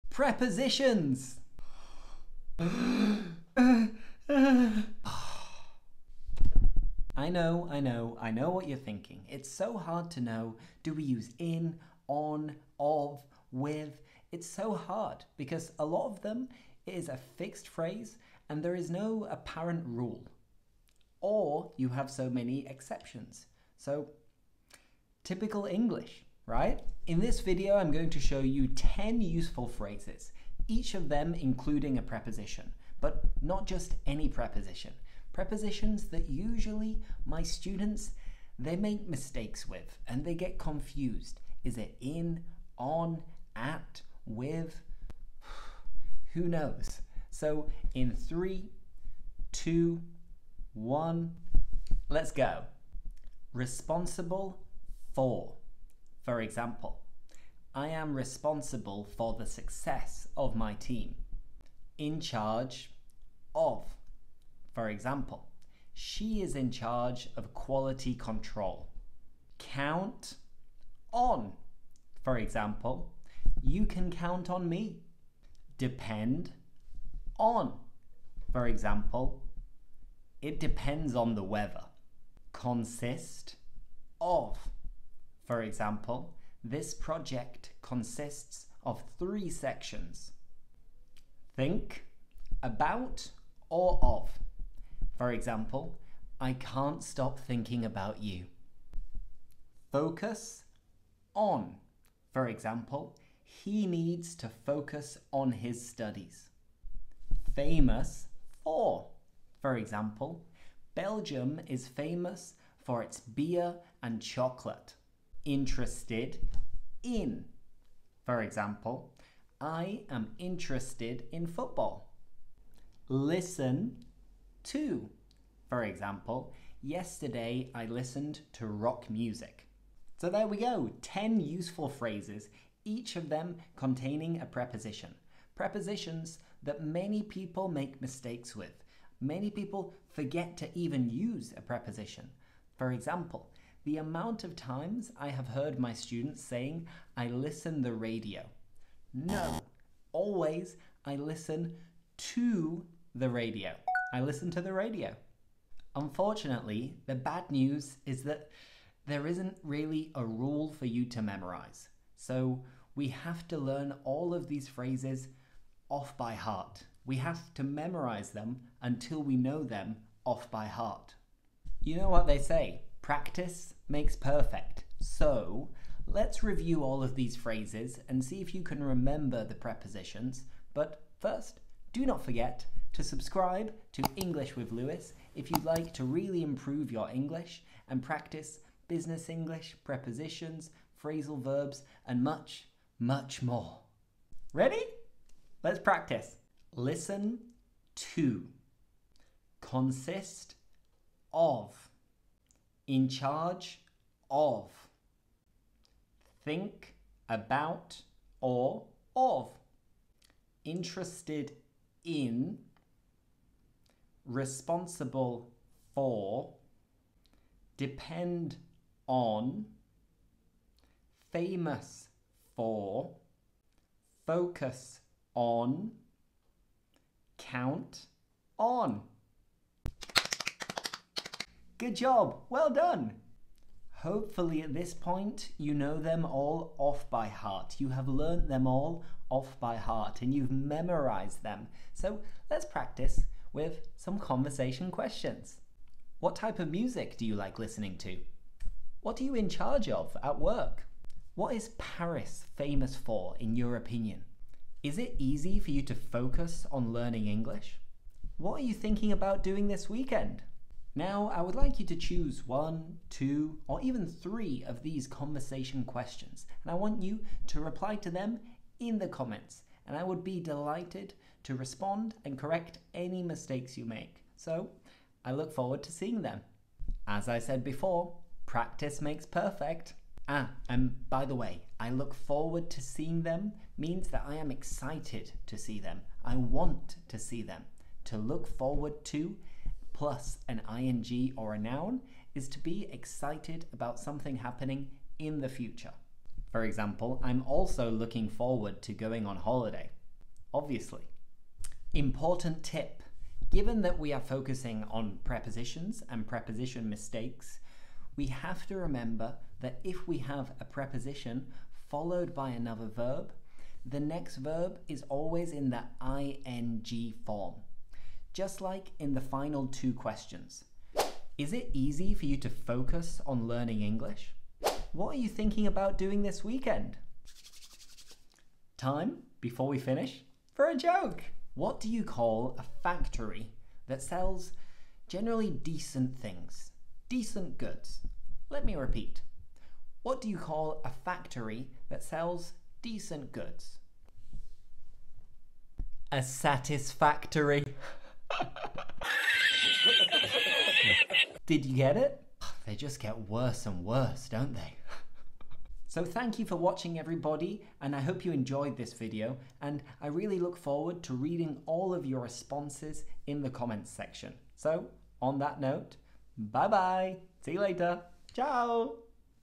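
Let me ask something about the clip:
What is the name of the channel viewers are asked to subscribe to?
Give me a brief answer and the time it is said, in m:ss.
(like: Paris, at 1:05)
English with Lewis, at 3:04.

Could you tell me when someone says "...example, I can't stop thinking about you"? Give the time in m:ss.
1:35.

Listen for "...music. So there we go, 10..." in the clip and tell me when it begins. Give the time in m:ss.
2:09.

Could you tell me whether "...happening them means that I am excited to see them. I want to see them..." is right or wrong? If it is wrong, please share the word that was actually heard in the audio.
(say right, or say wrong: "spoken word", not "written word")
wrong: "seeing", not "happening".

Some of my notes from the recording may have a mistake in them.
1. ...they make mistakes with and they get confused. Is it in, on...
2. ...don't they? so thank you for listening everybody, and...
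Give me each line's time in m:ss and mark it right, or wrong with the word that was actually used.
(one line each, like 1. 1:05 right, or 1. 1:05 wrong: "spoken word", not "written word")
1. 0:38 right
2. 5:54 wrong: "watching", not "listening".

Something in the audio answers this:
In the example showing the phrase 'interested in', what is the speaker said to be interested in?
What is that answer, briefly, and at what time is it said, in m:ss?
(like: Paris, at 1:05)
football, at 2:01.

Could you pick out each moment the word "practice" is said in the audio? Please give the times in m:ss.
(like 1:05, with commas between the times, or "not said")
2:53, 3:08, 3:15, 4:02, 4:38.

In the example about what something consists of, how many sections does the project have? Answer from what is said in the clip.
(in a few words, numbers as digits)
3.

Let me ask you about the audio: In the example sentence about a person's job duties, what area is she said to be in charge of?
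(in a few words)
quality control.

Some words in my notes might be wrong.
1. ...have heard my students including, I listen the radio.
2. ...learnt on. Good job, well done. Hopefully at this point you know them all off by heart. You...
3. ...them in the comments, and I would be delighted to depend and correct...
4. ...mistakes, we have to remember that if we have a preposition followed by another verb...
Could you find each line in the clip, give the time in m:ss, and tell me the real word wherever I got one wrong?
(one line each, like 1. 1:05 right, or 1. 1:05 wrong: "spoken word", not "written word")
1. 2:25 wrong: "saying", not "including"
2. 3:47 wrong: "count", not "learnt"
3. 4:28 wrong: "respond", not "depend"
4. 5:06 right.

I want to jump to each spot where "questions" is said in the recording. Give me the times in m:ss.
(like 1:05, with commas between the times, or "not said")
4:04, 4:25, 5:19.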